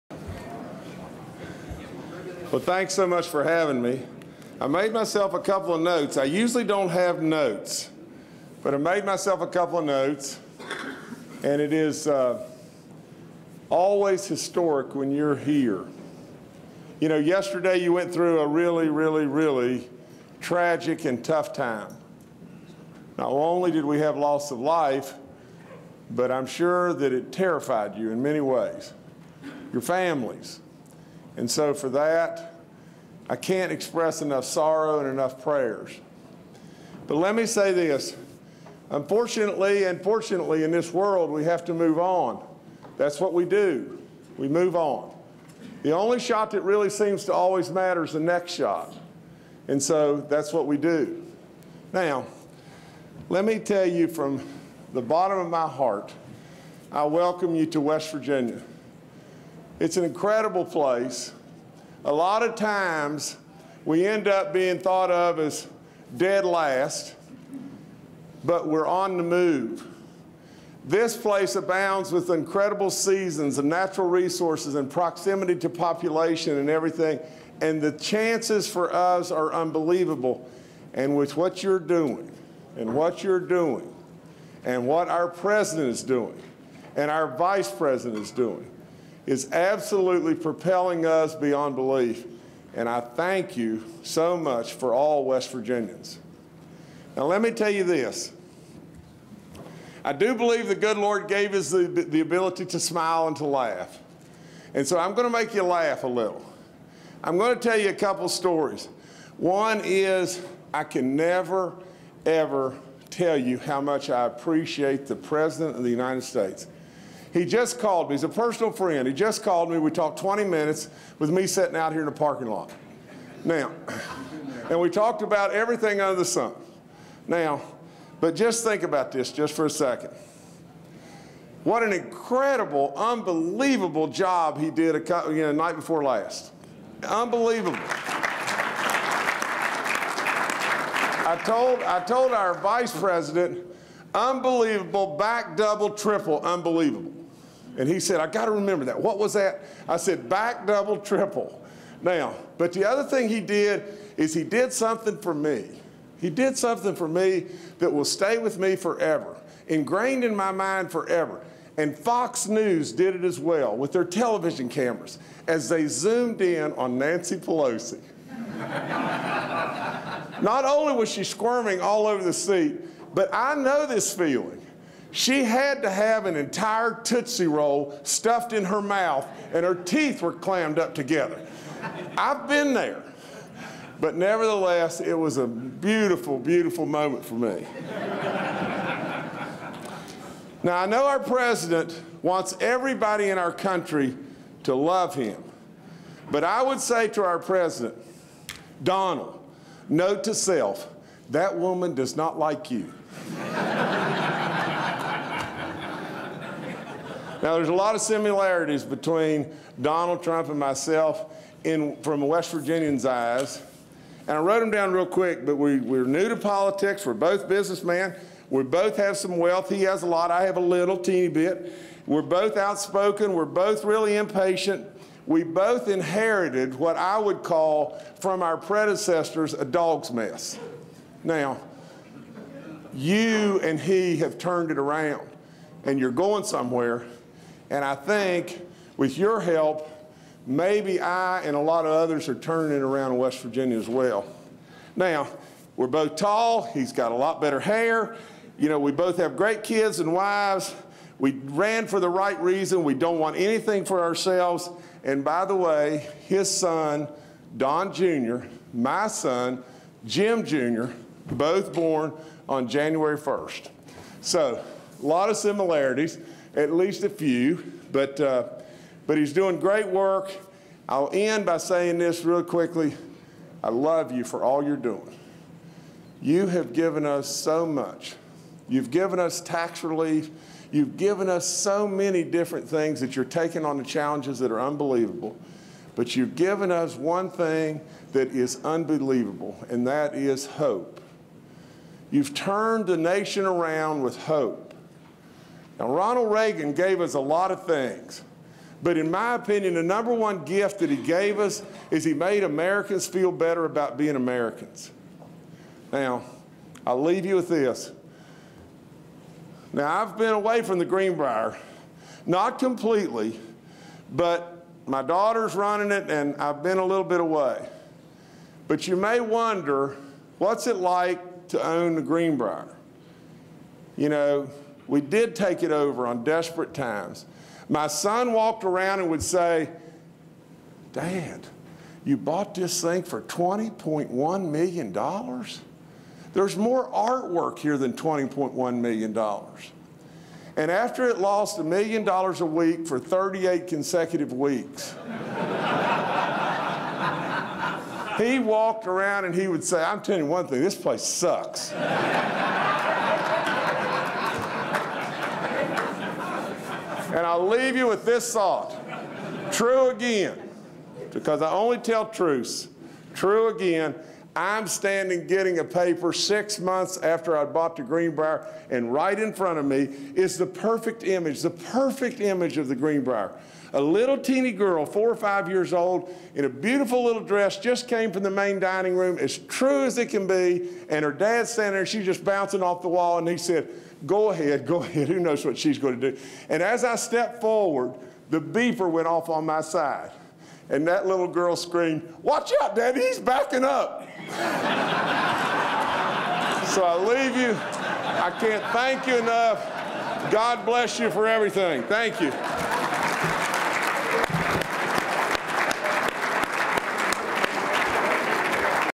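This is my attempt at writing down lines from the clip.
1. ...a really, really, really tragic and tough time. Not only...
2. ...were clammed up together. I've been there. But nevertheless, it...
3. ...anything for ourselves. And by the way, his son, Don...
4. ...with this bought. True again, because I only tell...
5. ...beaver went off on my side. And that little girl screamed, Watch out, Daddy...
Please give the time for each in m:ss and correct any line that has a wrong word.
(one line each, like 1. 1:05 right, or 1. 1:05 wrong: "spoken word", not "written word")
1. 0:18 right
2. 3:00 right
3. 4:13 right
4. 5:57 wrong: "thought", not "bought"
5. 6:28 right.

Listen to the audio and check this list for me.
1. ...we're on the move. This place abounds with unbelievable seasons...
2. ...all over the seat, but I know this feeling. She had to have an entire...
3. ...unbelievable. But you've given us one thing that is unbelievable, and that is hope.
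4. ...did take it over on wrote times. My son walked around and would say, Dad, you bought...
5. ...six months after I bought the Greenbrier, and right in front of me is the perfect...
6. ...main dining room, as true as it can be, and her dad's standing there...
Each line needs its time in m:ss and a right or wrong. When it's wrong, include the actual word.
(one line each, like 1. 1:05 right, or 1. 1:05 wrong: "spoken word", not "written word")
1. 1:08 wrong: "incredible", not "unbelievable"
2. 2:51 right
3. 4:44 right
4. 5:25 wrong: "desperate", not "wrote"
5. 6:06 right
6. 6:18 right.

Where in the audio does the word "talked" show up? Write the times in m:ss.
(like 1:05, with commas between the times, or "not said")
1:59, 2:04.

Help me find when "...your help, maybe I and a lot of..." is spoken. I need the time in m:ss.
3:59.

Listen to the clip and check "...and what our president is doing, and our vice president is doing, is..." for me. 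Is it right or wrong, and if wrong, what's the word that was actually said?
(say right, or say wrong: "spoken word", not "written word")
right.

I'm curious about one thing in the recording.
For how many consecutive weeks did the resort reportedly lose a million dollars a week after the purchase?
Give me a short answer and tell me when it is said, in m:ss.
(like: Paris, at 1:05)
38, at 5:42.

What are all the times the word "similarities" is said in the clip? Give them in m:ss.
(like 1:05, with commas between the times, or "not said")
3:28, 4:25.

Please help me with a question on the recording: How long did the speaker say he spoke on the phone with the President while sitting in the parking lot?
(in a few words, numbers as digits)
20 minutes.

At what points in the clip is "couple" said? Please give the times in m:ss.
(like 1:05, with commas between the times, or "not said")
0:05, 0:09, 1:47, 2:14.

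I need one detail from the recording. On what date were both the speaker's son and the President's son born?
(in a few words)
January 1.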